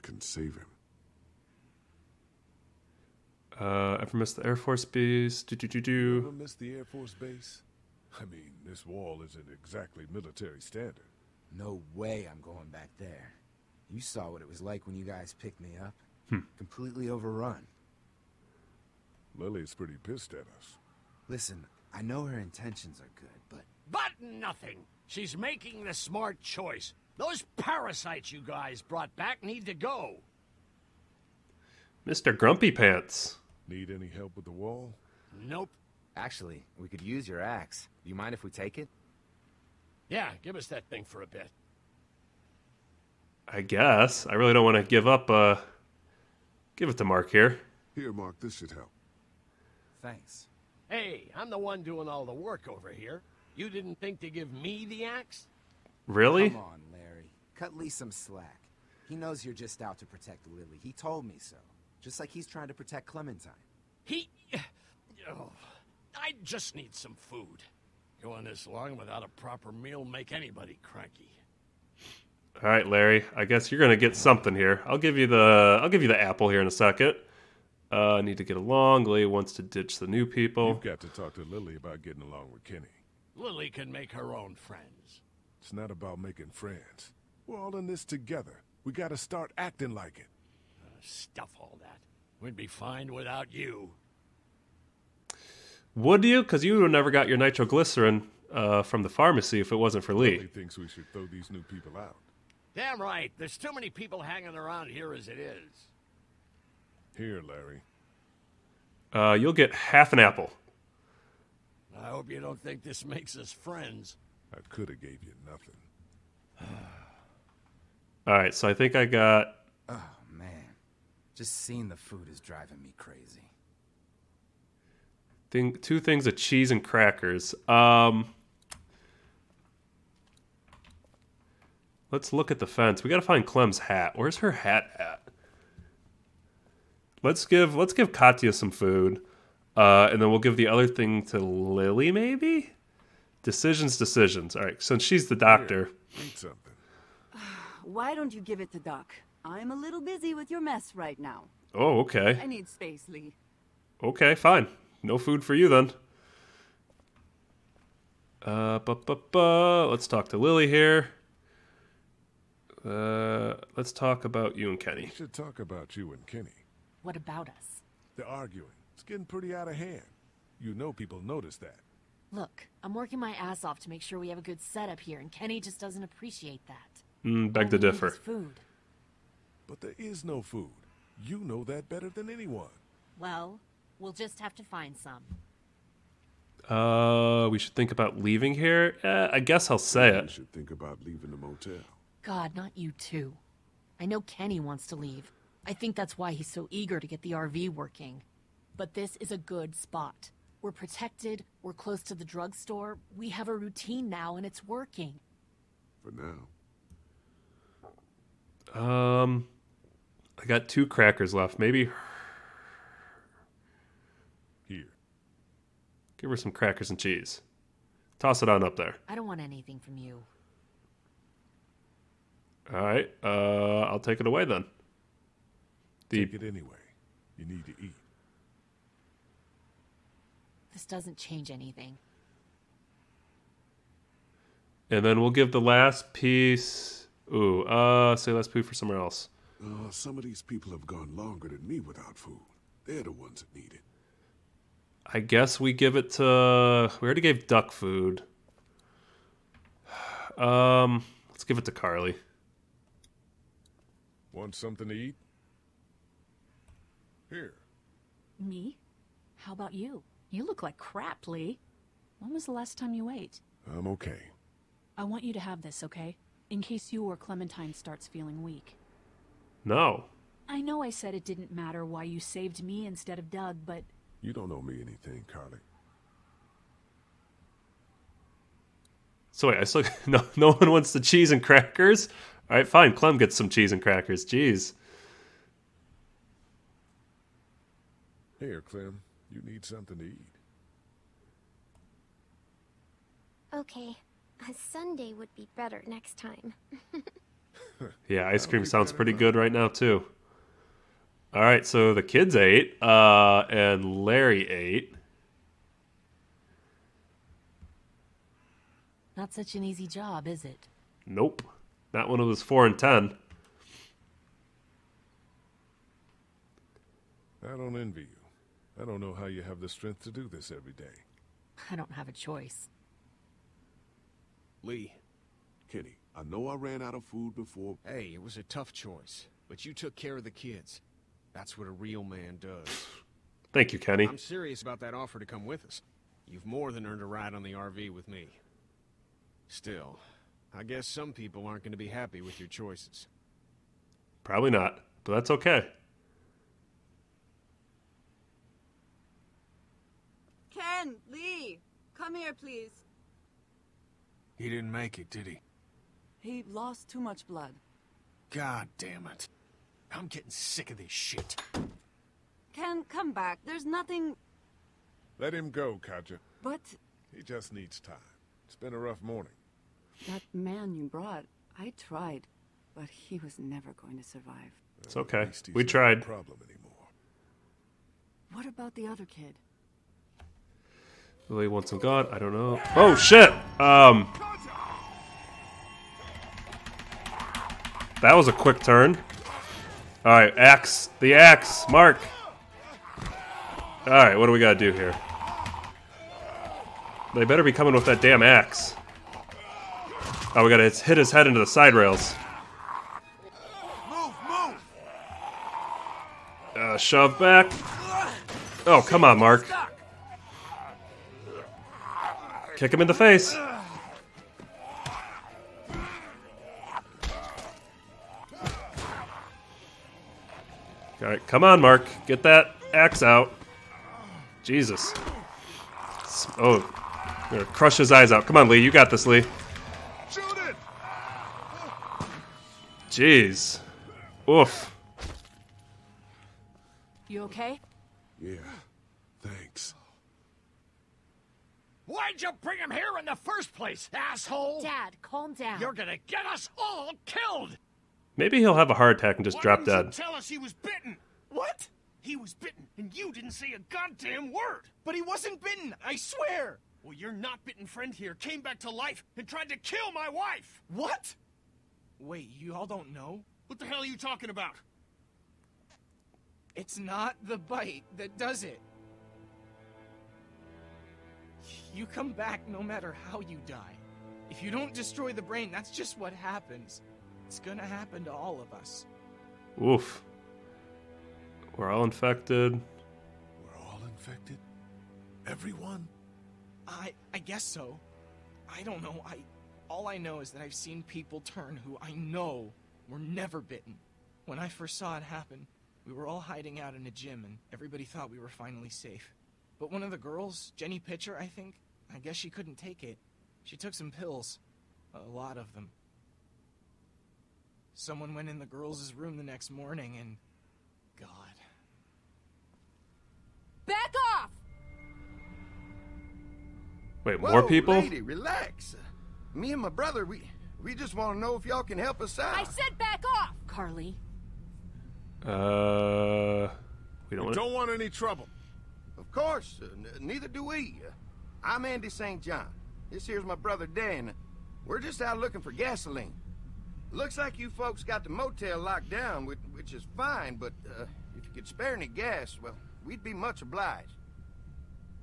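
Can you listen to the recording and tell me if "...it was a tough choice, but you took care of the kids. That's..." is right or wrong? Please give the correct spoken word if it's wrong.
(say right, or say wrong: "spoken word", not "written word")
right.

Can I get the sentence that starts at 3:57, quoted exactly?
Ooh, uh, say let's poo for somewhere else.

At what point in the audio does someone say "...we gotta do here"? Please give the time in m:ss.
6:34.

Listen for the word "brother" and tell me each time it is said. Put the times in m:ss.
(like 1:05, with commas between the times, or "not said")
8:39, 8:53.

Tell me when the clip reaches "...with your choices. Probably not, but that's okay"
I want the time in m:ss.
5:42.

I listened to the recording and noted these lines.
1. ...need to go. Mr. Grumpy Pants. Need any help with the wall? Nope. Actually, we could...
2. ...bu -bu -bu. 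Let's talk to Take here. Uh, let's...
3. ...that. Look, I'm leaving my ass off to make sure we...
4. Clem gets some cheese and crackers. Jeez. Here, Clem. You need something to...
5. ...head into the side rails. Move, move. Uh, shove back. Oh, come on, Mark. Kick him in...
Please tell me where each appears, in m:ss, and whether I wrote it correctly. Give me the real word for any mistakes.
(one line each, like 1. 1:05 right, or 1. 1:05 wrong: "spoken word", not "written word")
1. 0:29 right
2. 2:38 wrong: "Lily", not "Take"
3. 2:51 wrong: "working", not "leaving"
4. 4:42 right
5. 6:41 right.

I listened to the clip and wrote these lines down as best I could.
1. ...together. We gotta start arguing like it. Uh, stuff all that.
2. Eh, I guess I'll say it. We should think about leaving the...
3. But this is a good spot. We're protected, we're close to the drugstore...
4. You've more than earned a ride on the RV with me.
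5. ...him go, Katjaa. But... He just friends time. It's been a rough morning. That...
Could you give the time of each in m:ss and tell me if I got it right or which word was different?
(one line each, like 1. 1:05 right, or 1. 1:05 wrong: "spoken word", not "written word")
1. 1:28 wrong: "acting", not "arguing"
2. 3:09 right
3. 3:18 right
4. 5:36 right
5. 6:05 wrong: "needs", not "friends".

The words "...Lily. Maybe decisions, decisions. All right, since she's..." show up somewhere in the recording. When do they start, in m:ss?
2:21.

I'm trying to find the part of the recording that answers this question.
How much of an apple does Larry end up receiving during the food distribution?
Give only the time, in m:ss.
1:49.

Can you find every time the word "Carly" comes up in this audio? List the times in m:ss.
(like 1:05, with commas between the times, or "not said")
4:11, 4:35, 8:43.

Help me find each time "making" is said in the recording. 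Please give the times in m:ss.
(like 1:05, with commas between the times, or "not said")
0:25, 1:26.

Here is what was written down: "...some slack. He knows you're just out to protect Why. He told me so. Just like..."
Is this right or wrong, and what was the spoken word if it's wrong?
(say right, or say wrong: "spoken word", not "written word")
wrong: "Lily", not "Why".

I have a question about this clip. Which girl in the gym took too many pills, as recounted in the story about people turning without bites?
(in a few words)
Jenny Pitcher.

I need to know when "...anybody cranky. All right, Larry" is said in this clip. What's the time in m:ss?
1:10.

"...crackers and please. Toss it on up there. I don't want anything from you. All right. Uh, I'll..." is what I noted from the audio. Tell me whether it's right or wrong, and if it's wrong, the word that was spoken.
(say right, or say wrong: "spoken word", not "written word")
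wrong: "cheese", not "please".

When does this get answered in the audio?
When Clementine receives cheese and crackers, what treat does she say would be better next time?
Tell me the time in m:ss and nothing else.
4:54.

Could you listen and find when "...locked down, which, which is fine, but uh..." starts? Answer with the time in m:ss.
8:58.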